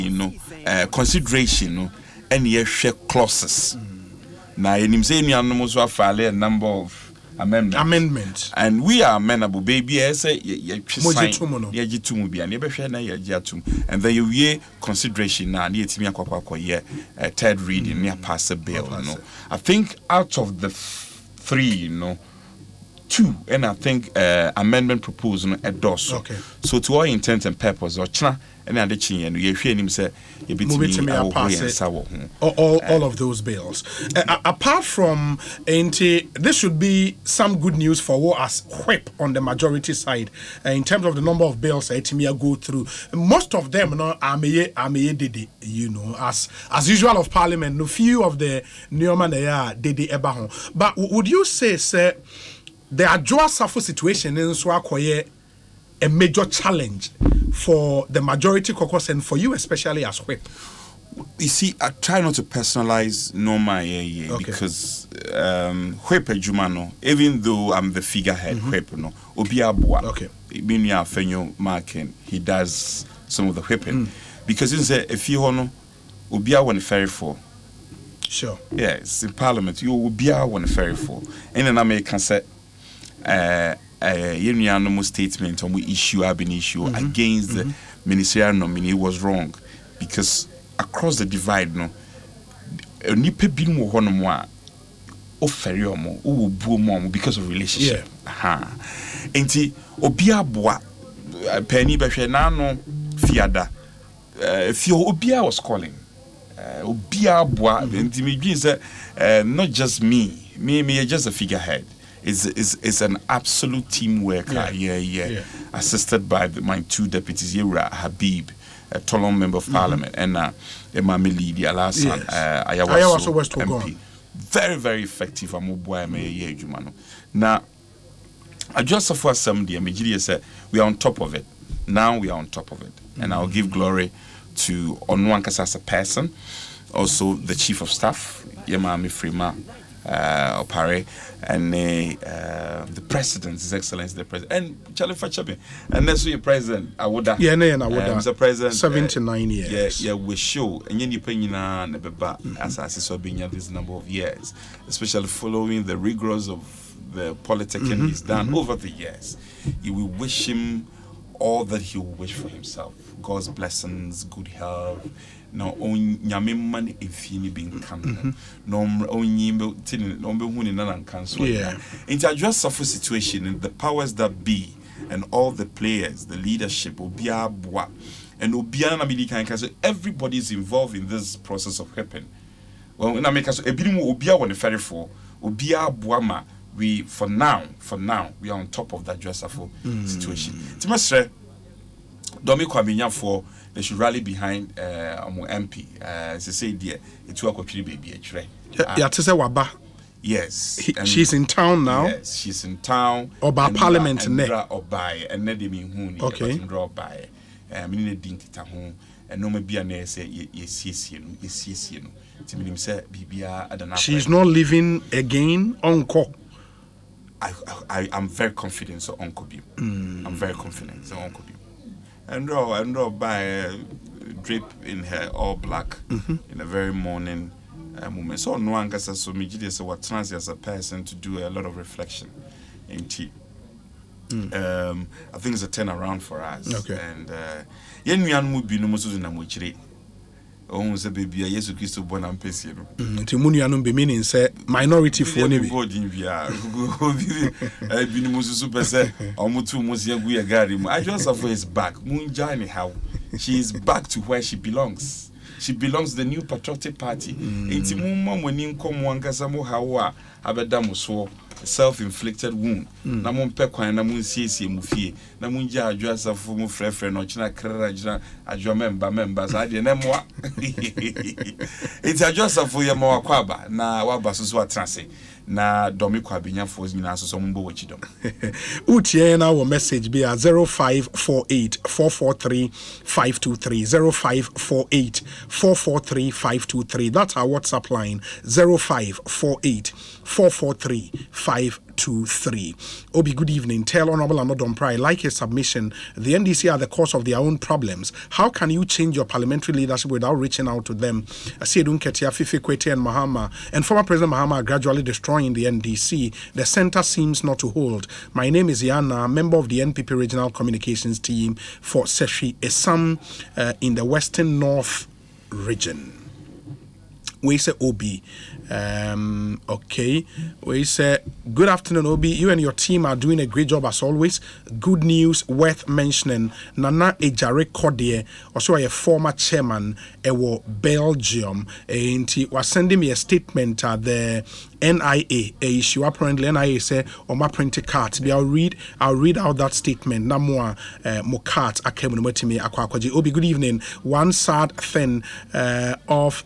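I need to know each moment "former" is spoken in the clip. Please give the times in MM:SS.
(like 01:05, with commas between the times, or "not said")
05:03, 05:28.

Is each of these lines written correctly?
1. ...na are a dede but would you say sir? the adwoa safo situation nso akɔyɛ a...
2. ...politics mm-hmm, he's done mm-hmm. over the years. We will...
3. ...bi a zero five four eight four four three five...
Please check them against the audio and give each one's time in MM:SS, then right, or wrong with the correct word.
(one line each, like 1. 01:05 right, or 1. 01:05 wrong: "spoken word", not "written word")
1. 00:49 right
2. 02:37 right
3. 04:40 right.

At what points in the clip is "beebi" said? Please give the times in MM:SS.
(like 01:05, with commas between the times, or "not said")
03:17, 04:01.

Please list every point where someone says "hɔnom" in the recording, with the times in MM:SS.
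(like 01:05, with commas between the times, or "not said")
01:33.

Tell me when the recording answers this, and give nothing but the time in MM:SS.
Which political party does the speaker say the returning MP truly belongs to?
04:16.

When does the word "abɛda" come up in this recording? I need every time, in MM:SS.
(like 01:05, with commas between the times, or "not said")
04:20.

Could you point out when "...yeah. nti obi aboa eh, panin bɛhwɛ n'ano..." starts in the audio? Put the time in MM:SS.
01:38.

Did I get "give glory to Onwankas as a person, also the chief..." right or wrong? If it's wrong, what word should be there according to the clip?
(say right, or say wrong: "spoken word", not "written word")
right.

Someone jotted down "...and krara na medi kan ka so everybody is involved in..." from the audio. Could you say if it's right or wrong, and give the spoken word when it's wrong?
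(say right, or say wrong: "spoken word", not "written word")
wrong: "obiara", not "krara".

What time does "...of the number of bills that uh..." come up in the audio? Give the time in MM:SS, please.
00:41.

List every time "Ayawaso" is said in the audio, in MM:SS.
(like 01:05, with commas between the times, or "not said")
02:02.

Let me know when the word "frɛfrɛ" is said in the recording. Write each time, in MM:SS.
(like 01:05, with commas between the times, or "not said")
04:26.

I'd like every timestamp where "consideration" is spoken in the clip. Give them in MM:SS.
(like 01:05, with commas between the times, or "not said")
00:00, 00:14.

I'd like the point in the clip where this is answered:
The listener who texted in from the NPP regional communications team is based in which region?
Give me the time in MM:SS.
05:14.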